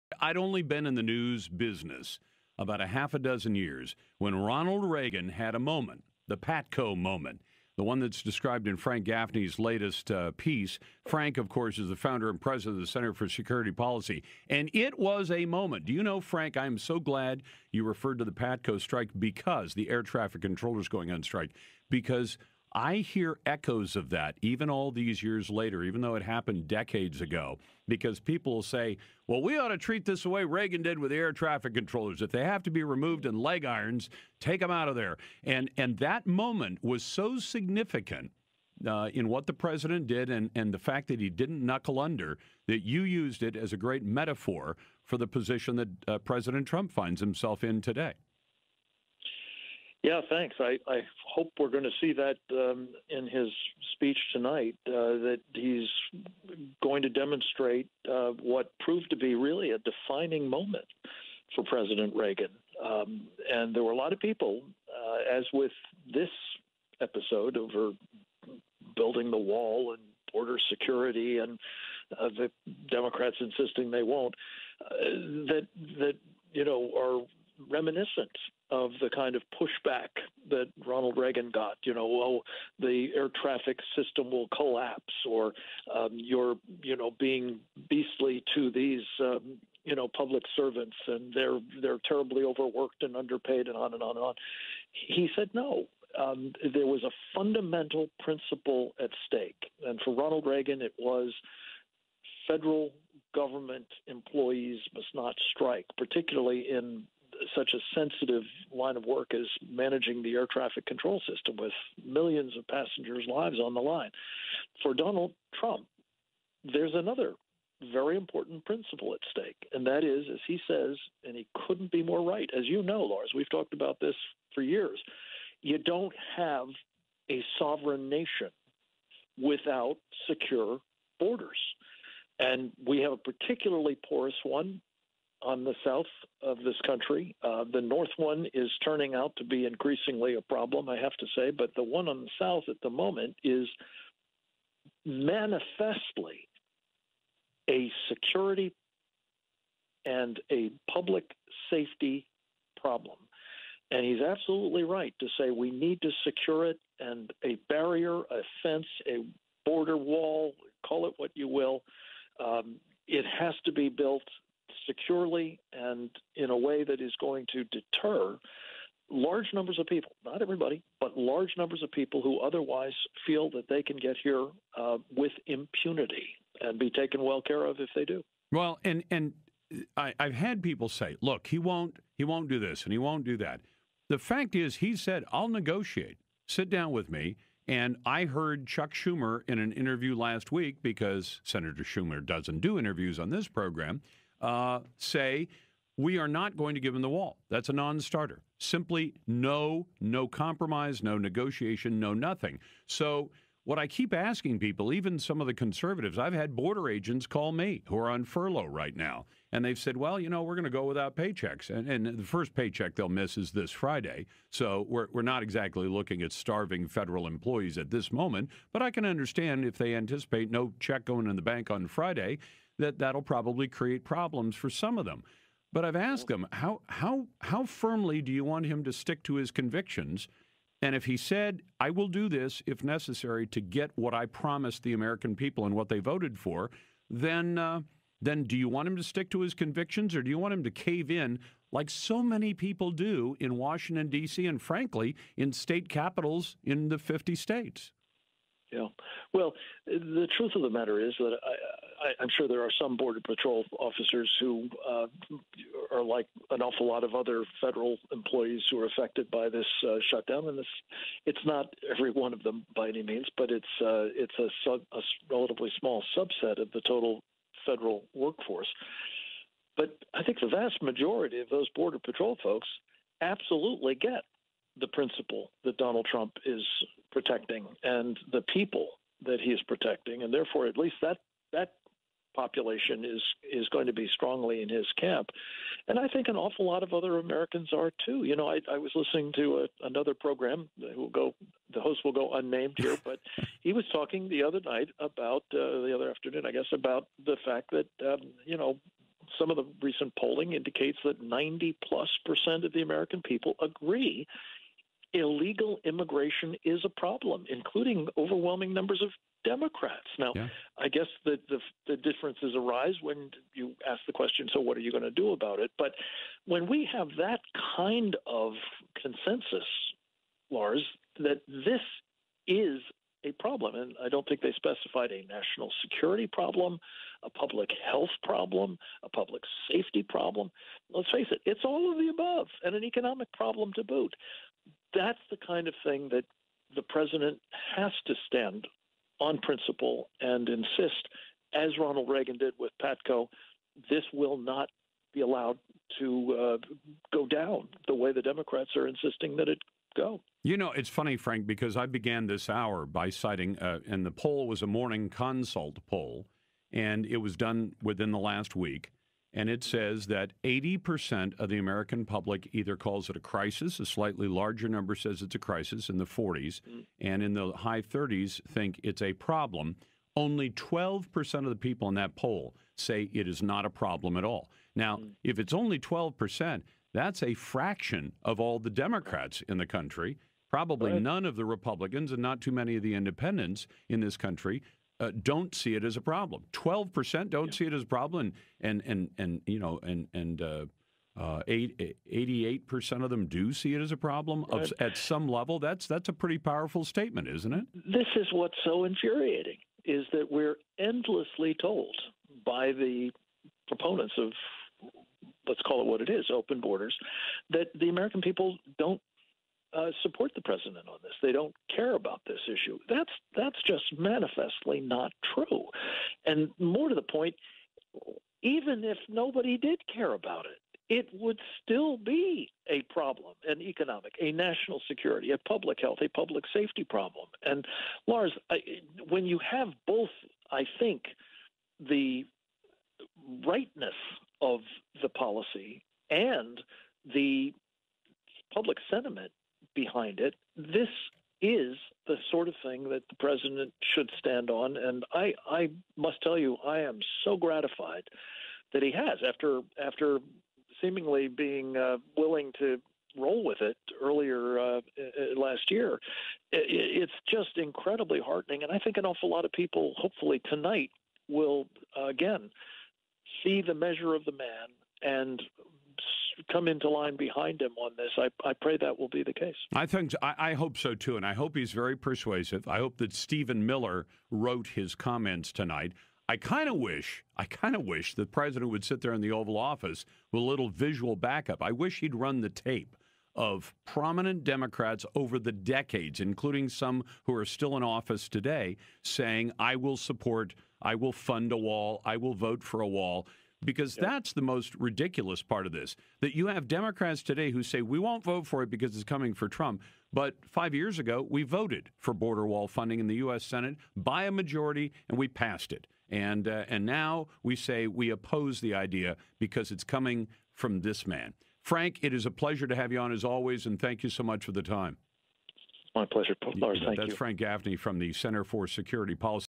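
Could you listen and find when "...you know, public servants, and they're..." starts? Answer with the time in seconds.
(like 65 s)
89 s.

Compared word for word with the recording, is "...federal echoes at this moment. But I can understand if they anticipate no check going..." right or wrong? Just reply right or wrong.
wrong.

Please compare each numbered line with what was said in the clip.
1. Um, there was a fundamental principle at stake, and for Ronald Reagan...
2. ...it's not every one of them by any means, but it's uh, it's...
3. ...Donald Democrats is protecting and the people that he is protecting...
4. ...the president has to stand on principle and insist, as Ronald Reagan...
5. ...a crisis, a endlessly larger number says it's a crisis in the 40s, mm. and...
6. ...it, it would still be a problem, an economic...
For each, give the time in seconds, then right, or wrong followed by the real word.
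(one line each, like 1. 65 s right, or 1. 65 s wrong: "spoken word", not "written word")
1. 96 s right
2. 261 s right
3. 275 s wrong: "Trump", not "Democrats"
4. 336 s right
5. 363 s wrong: "slightly", not "endlessly"
6. 420 s right.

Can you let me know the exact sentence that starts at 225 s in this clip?
But I've asked them how how how firmly do you want him to stick to his convictions?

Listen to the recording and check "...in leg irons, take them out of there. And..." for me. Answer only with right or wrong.
right.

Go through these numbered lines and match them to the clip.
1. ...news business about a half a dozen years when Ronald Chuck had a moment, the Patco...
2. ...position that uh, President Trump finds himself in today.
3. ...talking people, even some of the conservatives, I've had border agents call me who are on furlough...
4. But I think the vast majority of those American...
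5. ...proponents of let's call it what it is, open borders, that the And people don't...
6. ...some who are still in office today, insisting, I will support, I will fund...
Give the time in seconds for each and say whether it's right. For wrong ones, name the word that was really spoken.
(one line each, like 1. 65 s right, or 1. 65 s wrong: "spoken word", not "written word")
1. 1 s wrong: "Reagan", not "Chuck"
2. 45 s right
3. 204 s wrong: "asking", not "talking"
4. 269 s wrong: "Border", not "American"
5. 403 s wrong: "American", not "And"
6. 486 s wrong: "saying", not "insisting".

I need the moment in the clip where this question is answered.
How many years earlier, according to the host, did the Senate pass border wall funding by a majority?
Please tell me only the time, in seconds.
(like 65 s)
500 s.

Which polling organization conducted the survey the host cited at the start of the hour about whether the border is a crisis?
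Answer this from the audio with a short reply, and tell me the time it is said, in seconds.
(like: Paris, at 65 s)
Morning Consult, at 354 s.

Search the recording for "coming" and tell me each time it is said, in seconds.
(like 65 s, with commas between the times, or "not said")
499 s, 509 s.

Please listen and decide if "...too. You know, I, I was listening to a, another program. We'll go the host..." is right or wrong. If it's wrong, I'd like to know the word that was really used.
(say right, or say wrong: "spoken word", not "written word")
right.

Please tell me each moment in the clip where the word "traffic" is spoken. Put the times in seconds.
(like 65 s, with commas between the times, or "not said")
20 s, 31 s, 83 s, 110 s.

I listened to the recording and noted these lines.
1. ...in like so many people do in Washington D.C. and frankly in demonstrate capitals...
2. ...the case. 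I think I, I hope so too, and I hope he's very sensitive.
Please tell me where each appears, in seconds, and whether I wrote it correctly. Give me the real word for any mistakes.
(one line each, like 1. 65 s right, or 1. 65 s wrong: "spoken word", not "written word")
1. 241 s wrong: "state", not "demonstrate"
2. 469 s wrong: "persuasive", not "sensitive".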